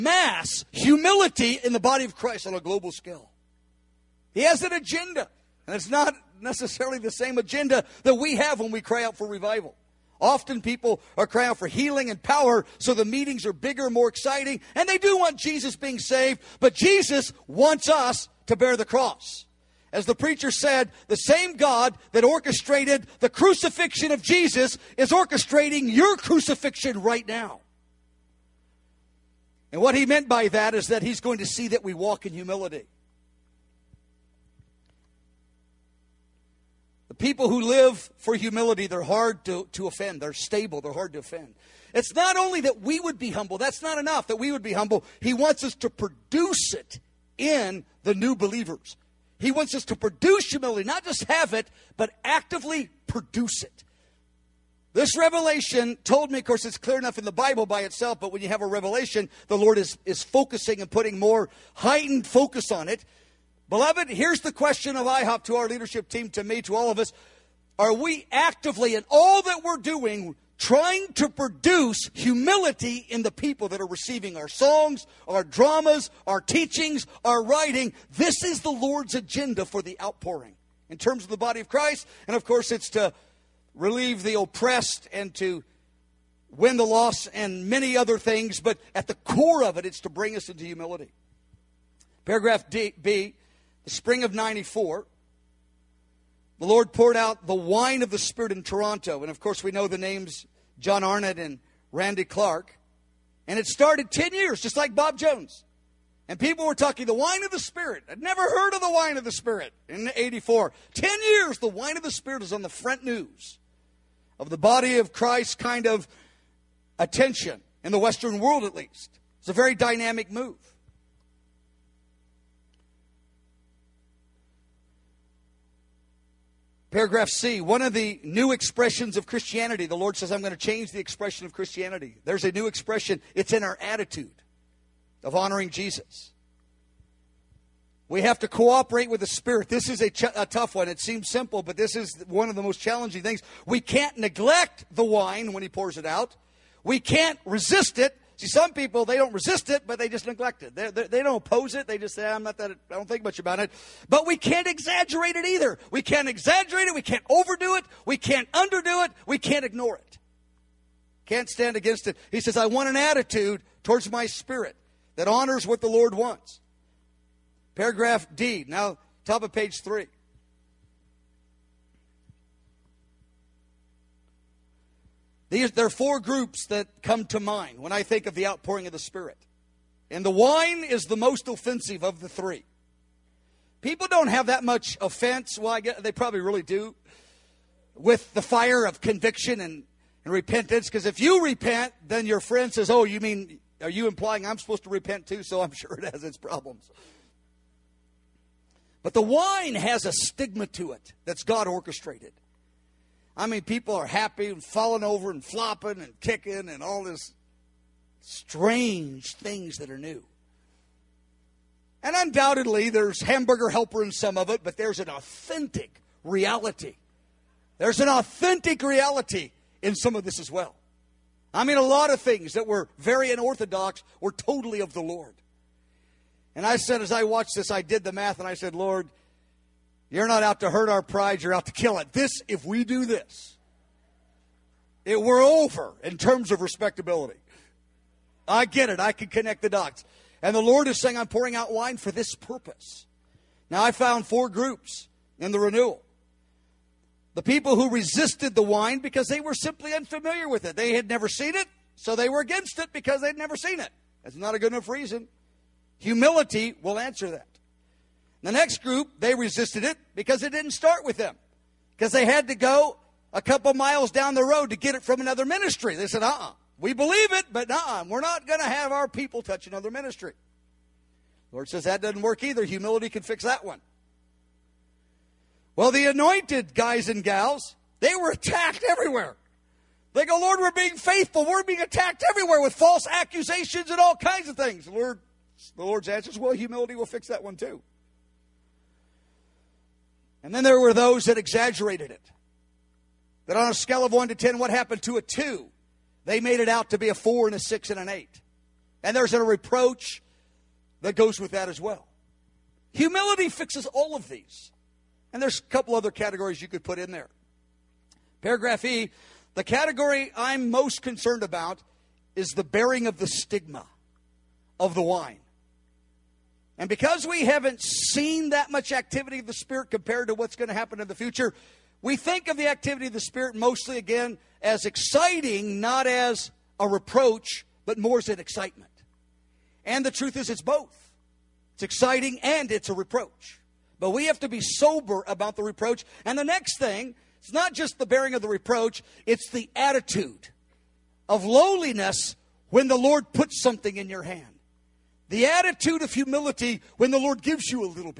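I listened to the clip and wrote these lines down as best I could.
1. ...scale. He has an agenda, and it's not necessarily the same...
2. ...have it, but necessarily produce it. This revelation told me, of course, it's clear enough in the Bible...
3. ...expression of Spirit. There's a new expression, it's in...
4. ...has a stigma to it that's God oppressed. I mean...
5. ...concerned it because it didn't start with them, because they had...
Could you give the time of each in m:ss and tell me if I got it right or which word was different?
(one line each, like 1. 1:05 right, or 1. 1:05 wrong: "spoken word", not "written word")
1. 0:02 right
2. 0:51 wrong: "actively", not "necessarily"
3. 2:10 wrong: "Christianity", not "Spirit"
4. 3:19 wrong: "orchestrated", not "oppressed"
5. 4:19 wrong: "resisted", not "concerned".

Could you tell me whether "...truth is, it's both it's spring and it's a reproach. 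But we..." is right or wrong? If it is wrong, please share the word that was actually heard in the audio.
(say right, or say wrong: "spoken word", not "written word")
wrong: "exciting", not "spring".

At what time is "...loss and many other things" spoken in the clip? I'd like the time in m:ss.
1:26.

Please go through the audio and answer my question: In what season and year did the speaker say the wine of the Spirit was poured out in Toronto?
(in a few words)
Spring of 94.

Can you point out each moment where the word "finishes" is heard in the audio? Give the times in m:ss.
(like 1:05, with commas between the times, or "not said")
not said.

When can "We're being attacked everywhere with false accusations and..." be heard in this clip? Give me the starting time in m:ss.
4:41.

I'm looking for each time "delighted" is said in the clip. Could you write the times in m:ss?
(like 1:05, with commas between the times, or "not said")
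not said.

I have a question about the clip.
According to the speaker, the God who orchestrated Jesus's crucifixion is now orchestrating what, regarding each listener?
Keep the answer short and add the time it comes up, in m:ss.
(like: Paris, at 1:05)
Your crucifixion, at 0:25.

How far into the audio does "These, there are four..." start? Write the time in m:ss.
2:55.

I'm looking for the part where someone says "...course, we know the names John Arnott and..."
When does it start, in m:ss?
1:39.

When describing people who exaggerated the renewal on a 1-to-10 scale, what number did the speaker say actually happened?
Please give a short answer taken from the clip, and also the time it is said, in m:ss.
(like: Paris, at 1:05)
2, at 4:55.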